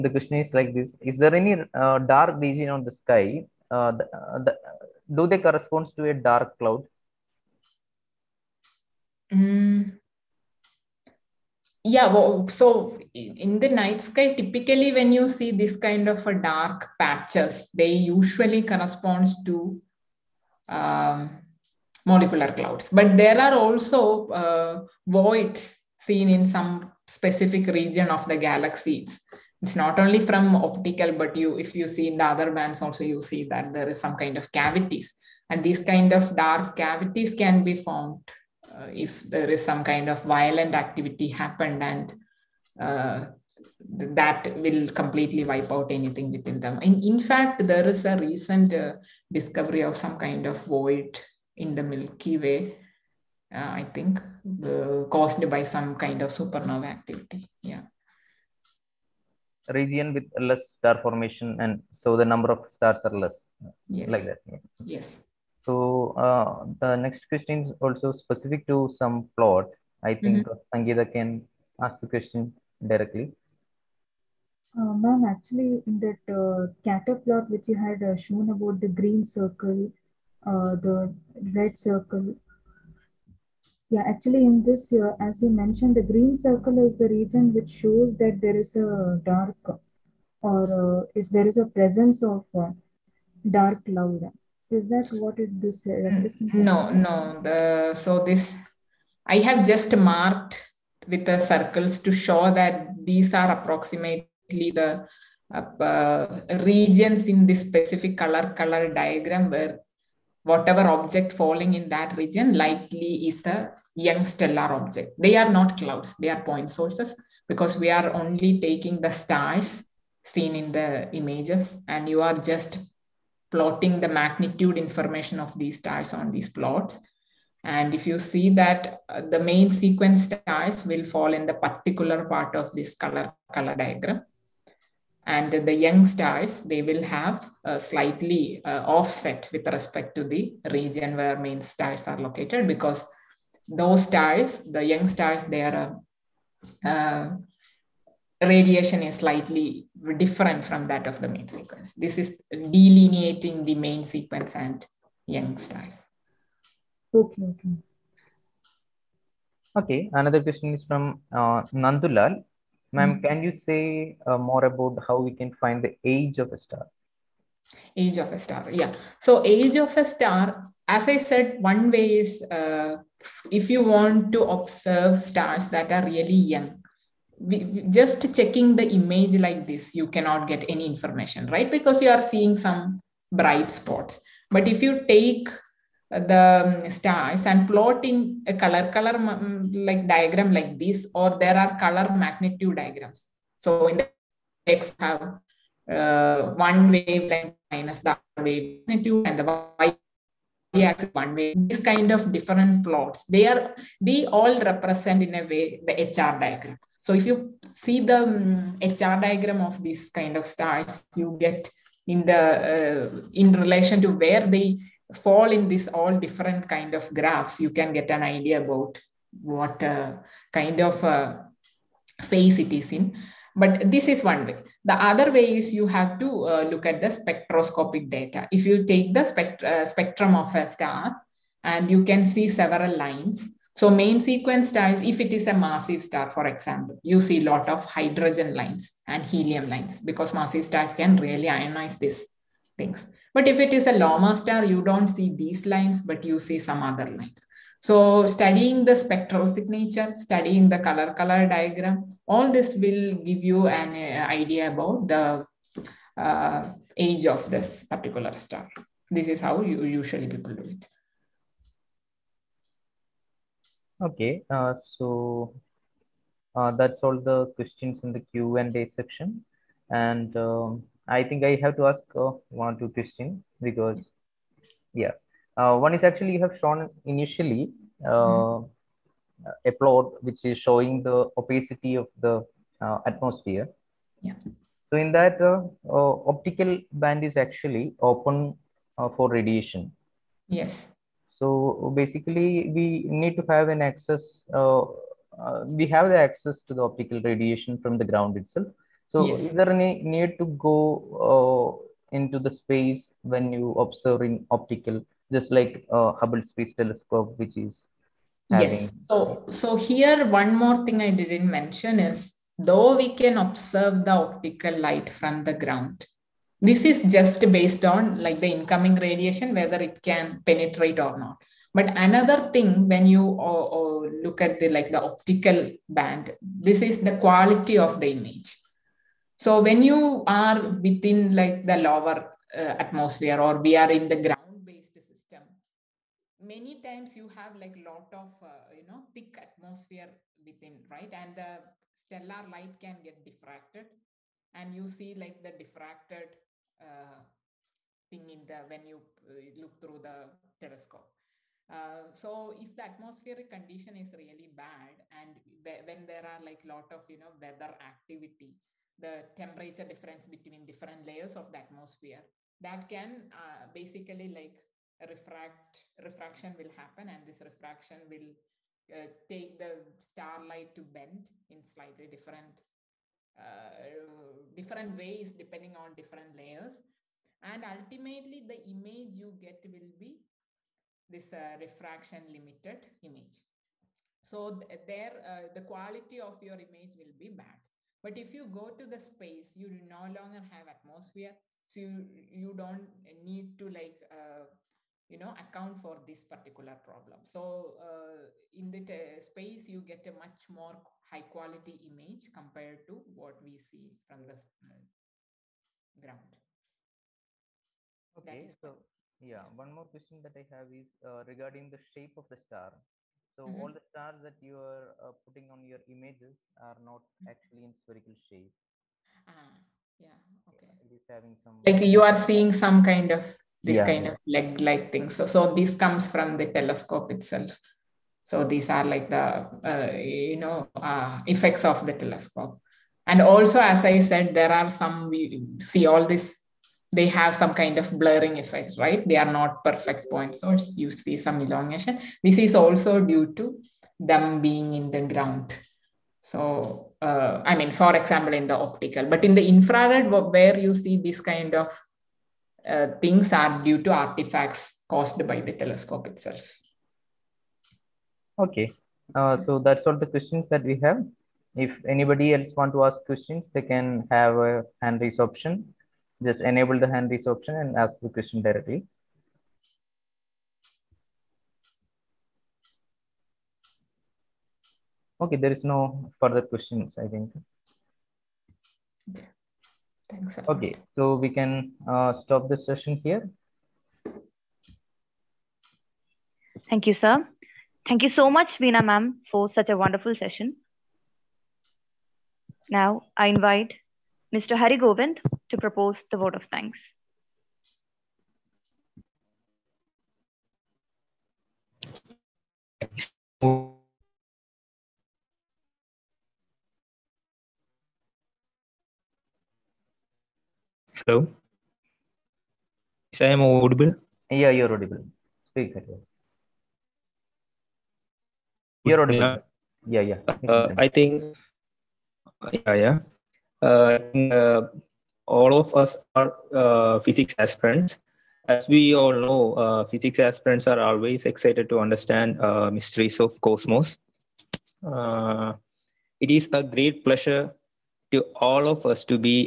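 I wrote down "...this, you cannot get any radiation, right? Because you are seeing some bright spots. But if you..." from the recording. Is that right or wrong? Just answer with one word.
wrong.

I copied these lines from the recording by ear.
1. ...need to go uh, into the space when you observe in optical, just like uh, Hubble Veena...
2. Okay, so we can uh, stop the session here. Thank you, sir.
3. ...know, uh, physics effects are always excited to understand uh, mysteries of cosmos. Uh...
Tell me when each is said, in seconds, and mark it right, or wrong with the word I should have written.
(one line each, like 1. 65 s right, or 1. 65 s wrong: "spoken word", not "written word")
1. 300 s wrong: "Space", not "Veena"
2. 480 s right
3. 529 s wrong: "aspirants", not "effects".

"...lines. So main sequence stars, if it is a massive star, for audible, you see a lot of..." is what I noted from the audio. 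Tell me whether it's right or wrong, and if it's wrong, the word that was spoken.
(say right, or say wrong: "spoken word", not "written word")
wrong: "example", not "audible".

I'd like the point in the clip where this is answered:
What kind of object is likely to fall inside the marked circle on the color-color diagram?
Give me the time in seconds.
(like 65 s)
113 s.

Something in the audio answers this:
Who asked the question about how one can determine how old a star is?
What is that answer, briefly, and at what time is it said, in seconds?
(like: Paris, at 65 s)
Nandulal, at 161 s.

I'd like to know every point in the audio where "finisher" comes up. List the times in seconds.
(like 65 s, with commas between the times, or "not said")
not said.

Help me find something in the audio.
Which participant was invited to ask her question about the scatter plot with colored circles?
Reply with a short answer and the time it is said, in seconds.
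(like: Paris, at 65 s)
Sangeeta, at 70 s.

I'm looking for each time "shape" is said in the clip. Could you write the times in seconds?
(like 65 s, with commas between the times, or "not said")
411 s, 418 s.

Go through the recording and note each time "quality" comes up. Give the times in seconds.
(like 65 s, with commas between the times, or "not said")
327 s, 385 s, 401 s.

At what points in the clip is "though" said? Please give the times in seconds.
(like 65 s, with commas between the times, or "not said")
312 s.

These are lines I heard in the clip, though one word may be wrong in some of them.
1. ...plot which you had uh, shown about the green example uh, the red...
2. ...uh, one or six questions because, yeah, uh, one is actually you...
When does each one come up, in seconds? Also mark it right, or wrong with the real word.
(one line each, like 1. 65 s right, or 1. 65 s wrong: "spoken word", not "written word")
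1. 77 s wrong: "circle", not "example"
2. 272 s wrong: "two", not "six".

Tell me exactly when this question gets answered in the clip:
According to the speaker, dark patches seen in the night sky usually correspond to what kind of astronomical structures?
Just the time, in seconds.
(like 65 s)
22 s.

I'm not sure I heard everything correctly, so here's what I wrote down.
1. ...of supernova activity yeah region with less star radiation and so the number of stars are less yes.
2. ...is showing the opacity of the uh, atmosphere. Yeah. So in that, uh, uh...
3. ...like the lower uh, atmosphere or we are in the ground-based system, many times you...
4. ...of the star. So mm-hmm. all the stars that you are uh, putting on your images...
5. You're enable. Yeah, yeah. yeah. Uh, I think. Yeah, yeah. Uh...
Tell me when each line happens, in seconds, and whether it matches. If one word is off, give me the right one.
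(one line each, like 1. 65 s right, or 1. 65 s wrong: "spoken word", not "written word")
1. 56 s wrong: "formation", not "radiation"
2. 280 s right
3. 331 s right
4. 412 s right
5. 518 s wrong: "audible", not "enable".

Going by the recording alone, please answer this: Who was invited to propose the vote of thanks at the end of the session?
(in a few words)
Hari Govind.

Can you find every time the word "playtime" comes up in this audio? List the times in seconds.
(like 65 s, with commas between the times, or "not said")
not said.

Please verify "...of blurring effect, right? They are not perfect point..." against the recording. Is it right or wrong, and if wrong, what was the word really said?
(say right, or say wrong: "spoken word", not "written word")
right.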